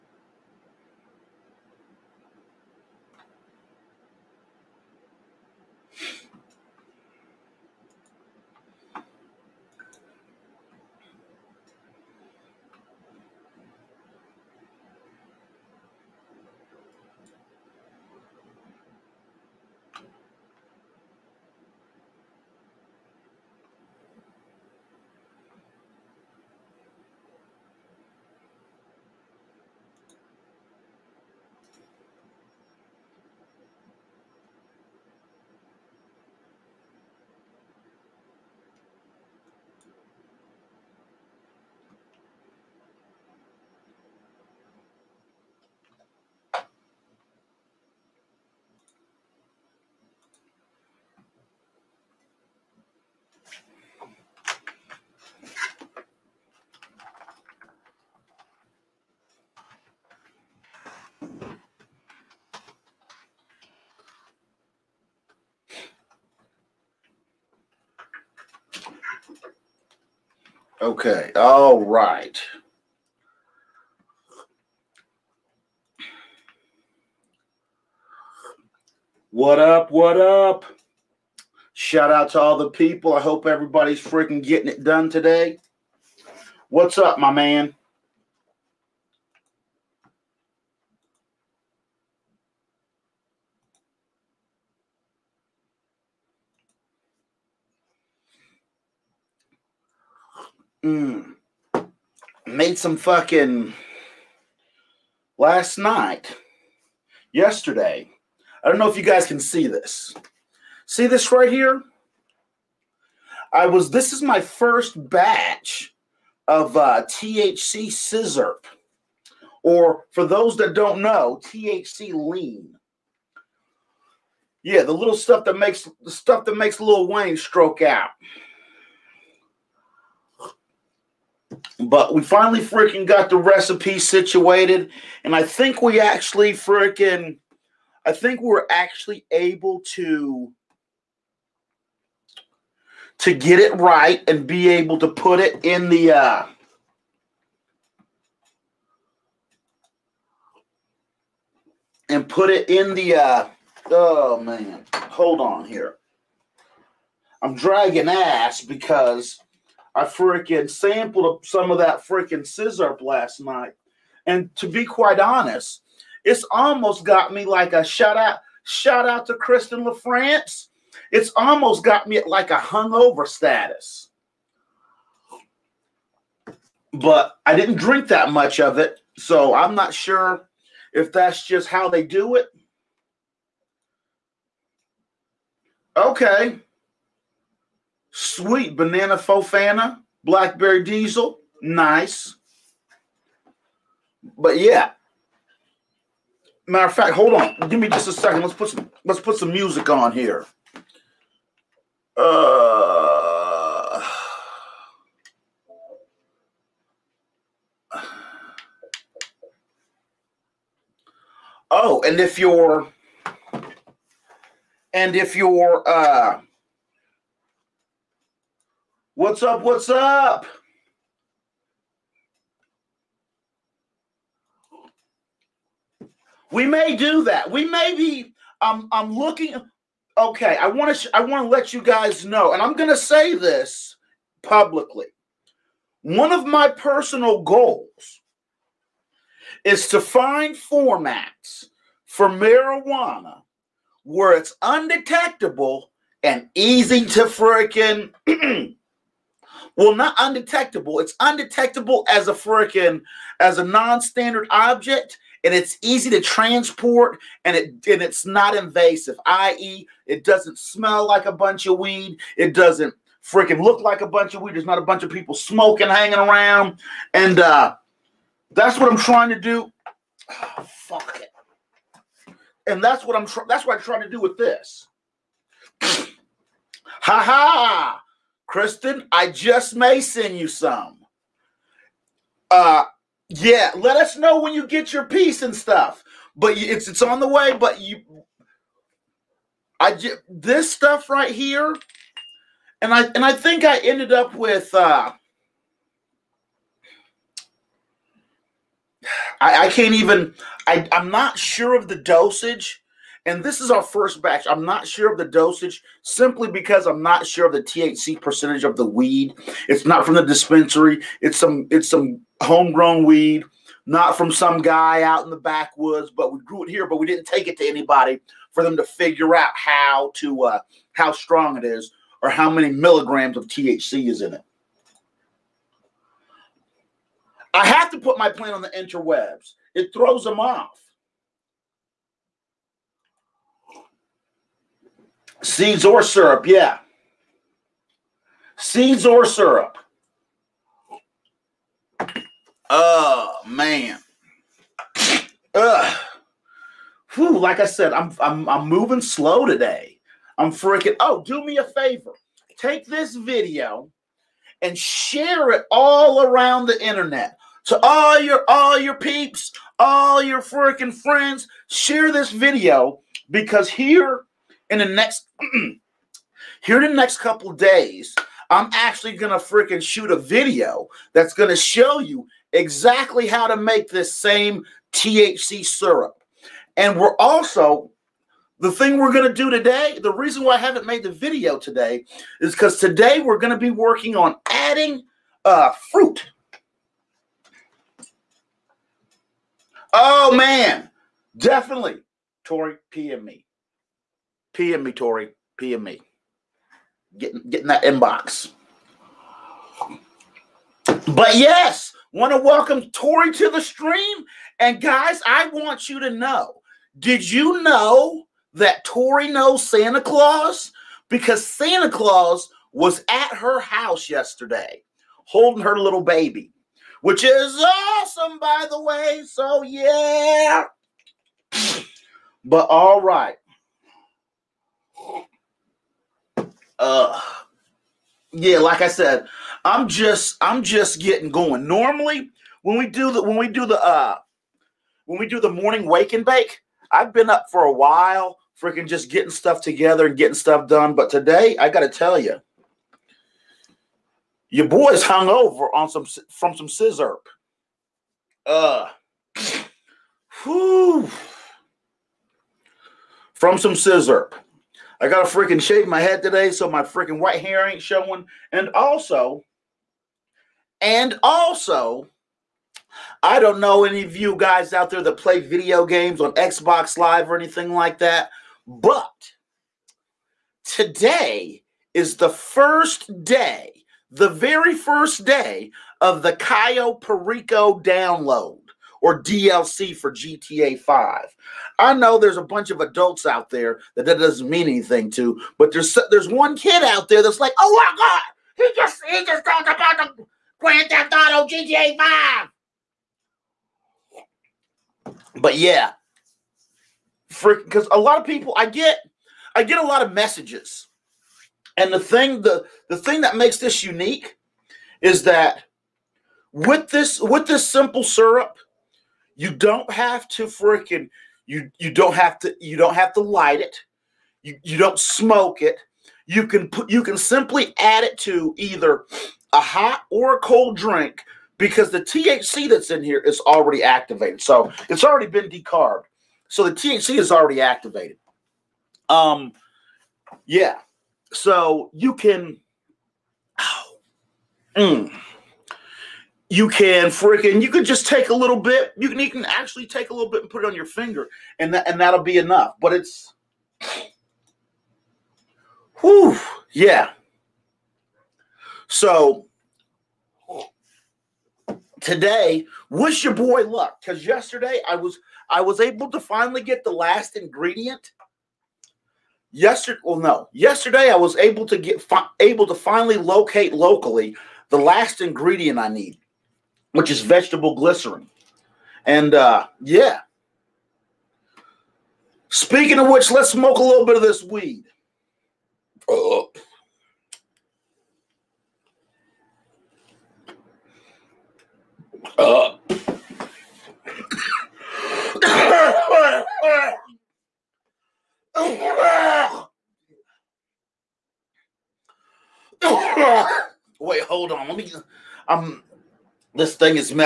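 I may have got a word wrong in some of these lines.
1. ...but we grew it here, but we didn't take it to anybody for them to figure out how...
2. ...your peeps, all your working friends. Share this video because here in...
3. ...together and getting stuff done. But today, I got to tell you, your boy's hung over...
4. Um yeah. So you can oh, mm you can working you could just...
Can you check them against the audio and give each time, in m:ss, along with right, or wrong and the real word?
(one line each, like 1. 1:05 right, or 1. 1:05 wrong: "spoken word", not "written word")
1. 5:16 right
2. 5:58 wrong: "freaking", not "working"
3. 7:19 right
4. 8:49 wrong: "freaking", not "working".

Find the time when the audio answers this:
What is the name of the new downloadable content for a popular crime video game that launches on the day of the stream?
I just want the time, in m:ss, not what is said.
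7:56.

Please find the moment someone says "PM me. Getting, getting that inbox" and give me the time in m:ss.
6:35.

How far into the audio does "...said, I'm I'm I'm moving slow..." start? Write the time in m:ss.
5:47.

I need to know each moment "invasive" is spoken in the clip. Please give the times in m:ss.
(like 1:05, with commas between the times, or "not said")
4:18.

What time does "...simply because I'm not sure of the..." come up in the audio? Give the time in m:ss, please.
5:06.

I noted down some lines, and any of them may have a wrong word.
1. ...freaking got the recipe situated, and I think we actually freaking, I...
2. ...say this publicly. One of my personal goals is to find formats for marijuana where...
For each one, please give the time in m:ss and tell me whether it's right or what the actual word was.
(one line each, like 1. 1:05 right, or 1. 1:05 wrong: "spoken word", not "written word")
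1. 2:12 right
2. 3:52 right.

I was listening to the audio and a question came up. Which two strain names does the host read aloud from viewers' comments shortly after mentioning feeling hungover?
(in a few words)
Sweet banana fofana, blackberry diesel.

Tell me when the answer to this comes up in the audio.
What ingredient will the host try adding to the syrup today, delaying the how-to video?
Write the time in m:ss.
6:25.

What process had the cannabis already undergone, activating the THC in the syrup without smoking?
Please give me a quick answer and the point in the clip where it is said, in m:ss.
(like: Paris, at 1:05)
Decarbed, at 8:45.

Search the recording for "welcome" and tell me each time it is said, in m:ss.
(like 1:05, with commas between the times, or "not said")
6:42.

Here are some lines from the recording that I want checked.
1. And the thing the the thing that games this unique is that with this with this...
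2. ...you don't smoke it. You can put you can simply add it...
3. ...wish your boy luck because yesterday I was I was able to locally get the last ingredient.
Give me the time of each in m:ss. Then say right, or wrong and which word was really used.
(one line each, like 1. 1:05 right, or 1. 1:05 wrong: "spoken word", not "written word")
1. 8:21 wrong: "makes", not "games"
2. 8:34 right
3. 9:12 wrong: "finally", not "locally".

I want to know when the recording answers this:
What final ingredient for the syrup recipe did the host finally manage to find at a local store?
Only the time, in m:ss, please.
9:27.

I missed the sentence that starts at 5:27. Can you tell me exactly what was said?
I have to put my plant on the interwebs.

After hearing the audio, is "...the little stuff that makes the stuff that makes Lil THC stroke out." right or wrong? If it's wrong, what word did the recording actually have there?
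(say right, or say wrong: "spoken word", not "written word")
wrong: "Wayne", not "THC".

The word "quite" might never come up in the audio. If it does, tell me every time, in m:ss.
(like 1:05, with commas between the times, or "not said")
2:44.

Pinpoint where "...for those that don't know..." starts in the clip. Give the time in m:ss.
2:00.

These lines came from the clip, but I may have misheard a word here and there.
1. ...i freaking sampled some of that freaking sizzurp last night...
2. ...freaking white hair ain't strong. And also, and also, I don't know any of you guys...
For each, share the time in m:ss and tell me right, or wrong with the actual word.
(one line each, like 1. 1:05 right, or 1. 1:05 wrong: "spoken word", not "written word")
1. 2:39 right
2. 7:36 wrong: "showing", not "strong".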